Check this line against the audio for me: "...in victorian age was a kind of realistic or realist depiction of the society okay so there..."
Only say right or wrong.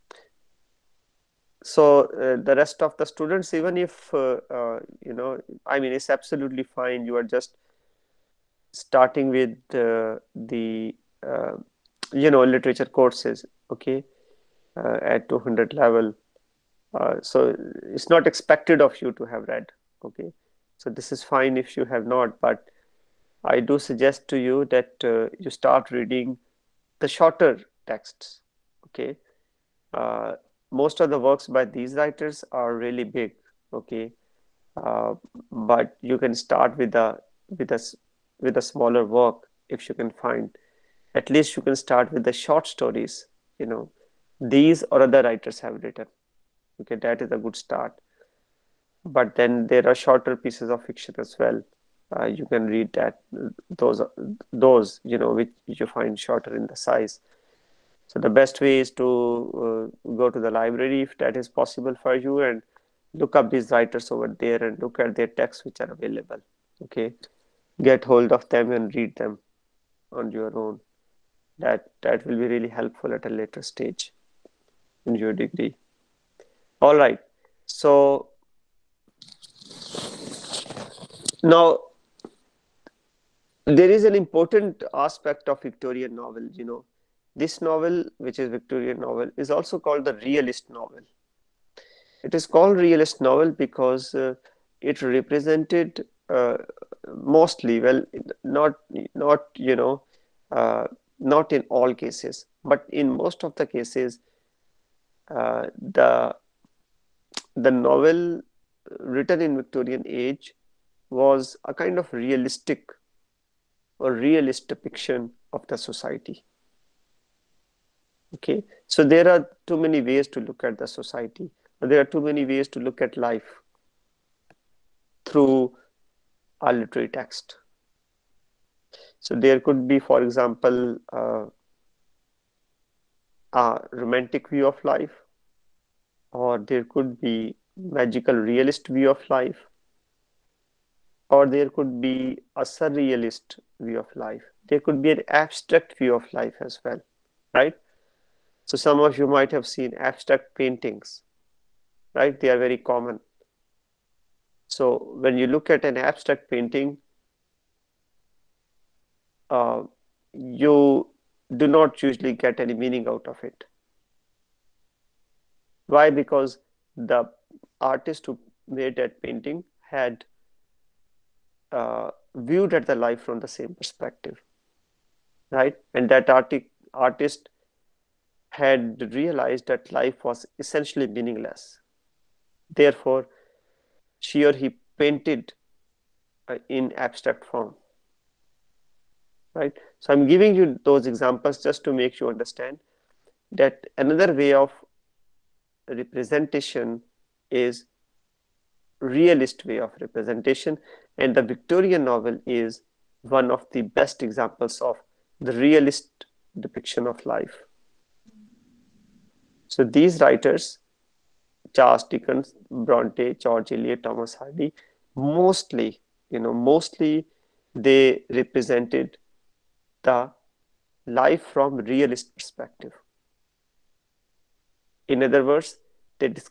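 right.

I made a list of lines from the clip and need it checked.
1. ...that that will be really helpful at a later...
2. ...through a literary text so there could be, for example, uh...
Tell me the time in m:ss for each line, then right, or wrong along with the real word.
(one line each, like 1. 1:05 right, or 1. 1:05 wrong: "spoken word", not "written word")
1. 1:11 right
2. 2:05 right.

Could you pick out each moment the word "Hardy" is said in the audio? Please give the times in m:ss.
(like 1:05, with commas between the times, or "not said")
3:34.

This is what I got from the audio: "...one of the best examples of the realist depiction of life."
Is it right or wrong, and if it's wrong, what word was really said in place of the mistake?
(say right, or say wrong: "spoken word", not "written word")
right.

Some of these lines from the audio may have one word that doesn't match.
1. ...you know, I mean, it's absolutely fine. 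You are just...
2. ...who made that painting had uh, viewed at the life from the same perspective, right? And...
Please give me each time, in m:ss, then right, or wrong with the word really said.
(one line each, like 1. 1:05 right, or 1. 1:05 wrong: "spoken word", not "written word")
1. 0:05 right
2. 2:48 right.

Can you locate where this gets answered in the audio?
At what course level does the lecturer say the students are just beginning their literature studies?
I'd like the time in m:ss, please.
0:15.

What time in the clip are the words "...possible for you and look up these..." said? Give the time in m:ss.
1:01.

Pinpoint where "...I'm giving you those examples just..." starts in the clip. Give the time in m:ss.
3:10.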